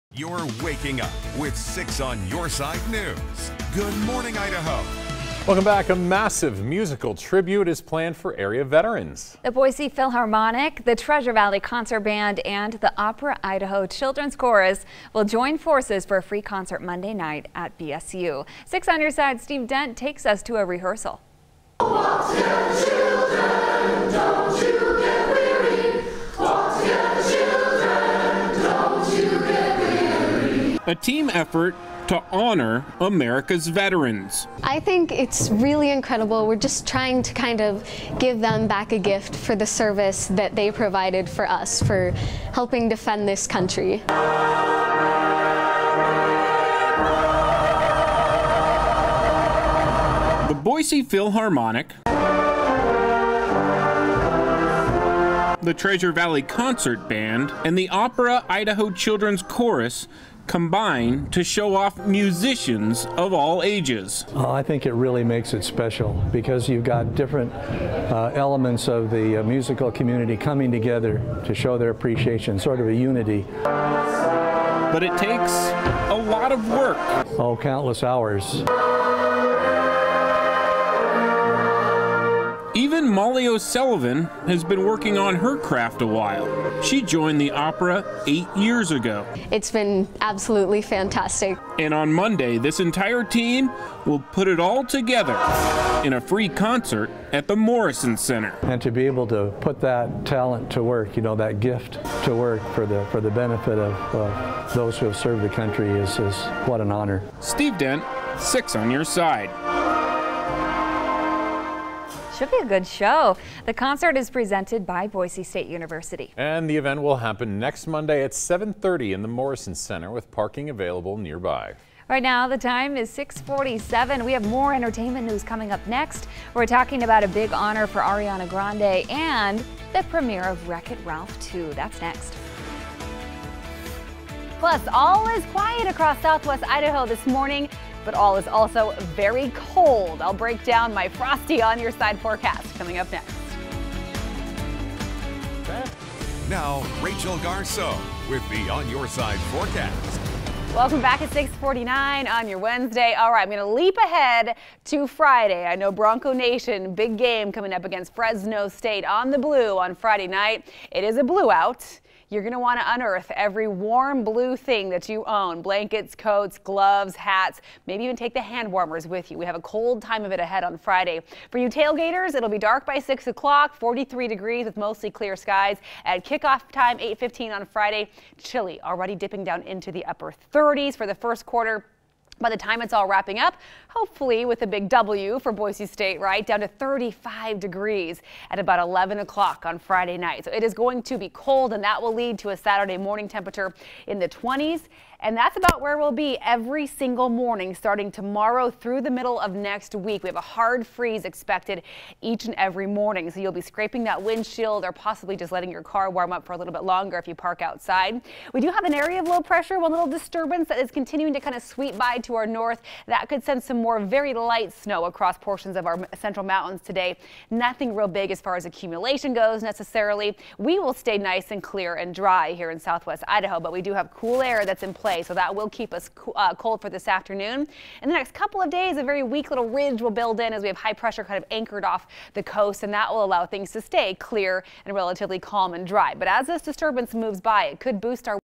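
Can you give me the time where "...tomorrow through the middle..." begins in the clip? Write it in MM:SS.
03:18.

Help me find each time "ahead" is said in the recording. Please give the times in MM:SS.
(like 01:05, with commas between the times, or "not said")
02:33, 02:50.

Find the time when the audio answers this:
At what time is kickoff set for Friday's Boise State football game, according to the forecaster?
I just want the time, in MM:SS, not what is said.
02:56.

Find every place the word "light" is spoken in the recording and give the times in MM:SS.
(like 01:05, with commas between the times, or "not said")
03:34.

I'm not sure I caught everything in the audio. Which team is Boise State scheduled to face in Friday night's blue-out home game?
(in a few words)
Fresno State.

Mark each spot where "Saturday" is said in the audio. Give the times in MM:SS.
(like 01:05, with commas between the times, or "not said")
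03:12.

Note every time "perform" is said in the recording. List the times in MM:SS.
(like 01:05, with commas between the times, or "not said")
not said.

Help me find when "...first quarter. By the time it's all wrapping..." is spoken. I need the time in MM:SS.
03:01.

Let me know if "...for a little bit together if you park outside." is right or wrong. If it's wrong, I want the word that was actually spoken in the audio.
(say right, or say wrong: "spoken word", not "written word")
wrong: "longer", not "together".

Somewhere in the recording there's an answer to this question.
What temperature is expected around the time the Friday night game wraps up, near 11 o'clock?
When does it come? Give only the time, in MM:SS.
03:06.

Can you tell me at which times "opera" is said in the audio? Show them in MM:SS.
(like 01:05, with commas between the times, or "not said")
00:13, 00:57, 01:27.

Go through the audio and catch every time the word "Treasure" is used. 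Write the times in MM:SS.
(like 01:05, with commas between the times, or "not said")
00:10, 00:55.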